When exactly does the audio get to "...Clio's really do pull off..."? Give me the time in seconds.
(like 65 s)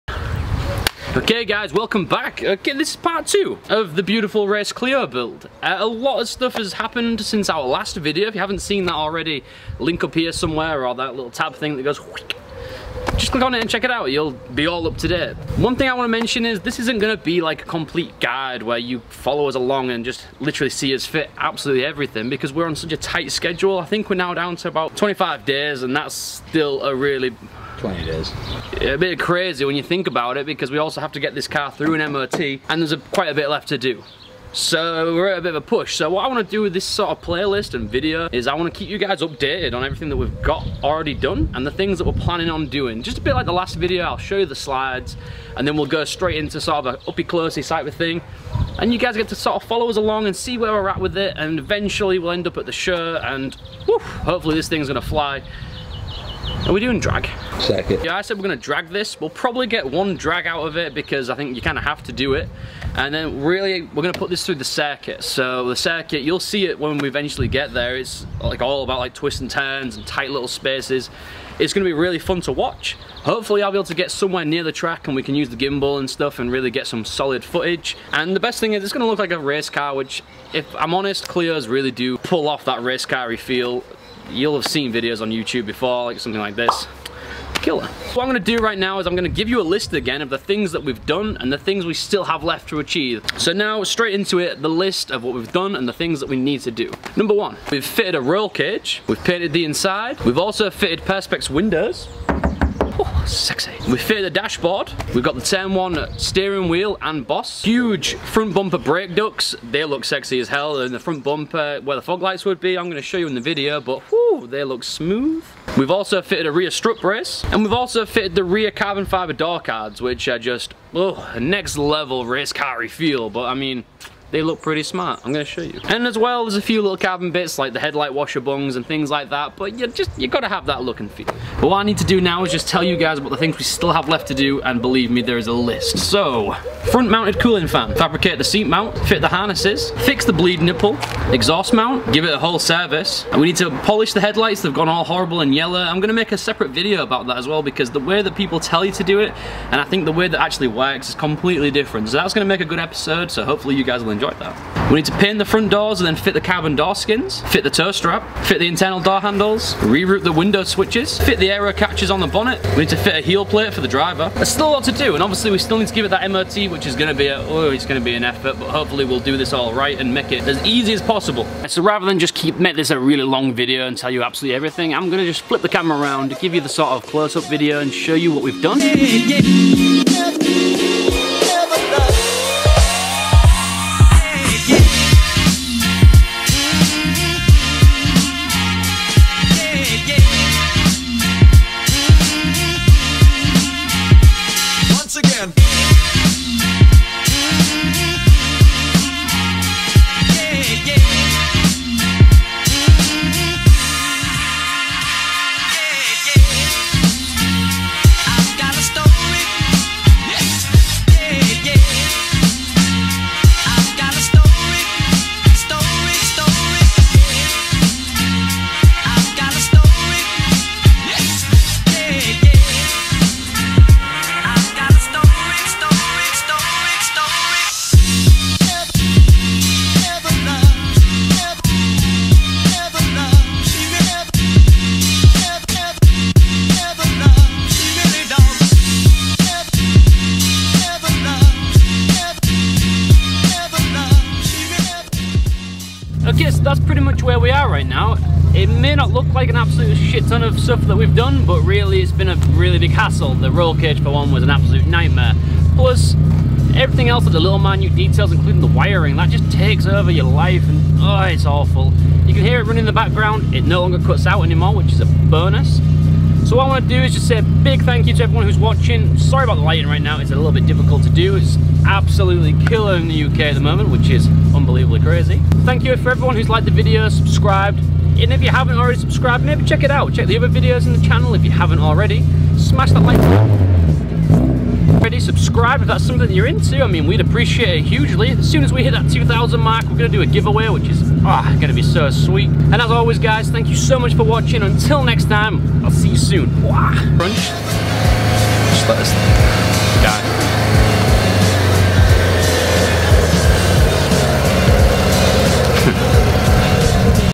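81 s.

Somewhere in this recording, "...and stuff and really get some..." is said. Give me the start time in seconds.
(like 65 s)
75 s.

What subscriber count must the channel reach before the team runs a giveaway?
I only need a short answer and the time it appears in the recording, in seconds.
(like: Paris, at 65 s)
2,000, at 289 s.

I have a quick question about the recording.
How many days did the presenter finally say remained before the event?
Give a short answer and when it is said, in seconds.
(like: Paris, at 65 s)
20 days, at 27 s.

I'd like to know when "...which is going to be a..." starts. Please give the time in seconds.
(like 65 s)
166 s.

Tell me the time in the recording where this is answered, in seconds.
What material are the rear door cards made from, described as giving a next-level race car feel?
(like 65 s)
118 s.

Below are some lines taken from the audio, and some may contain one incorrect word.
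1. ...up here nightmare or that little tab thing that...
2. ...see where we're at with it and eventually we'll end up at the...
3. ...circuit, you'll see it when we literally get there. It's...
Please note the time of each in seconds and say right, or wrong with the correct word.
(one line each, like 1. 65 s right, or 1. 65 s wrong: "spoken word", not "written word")
1. 10 s wrong: "somewhere", not "nightmare"
2. 50 s right
3. 65 s wrong: "eventually", not "literally".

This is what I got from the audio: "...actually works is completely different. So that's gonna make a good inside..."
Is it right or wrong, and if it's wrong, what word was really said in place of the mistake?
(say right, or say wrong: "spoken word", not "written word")
wrong: "episode", not "inside".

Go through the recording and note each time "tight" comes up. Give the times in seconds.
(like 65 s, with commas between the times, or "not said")
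22 s, 70 s.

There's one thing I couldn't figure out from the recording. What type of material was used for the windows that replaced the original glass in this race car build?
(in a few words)
Perspex.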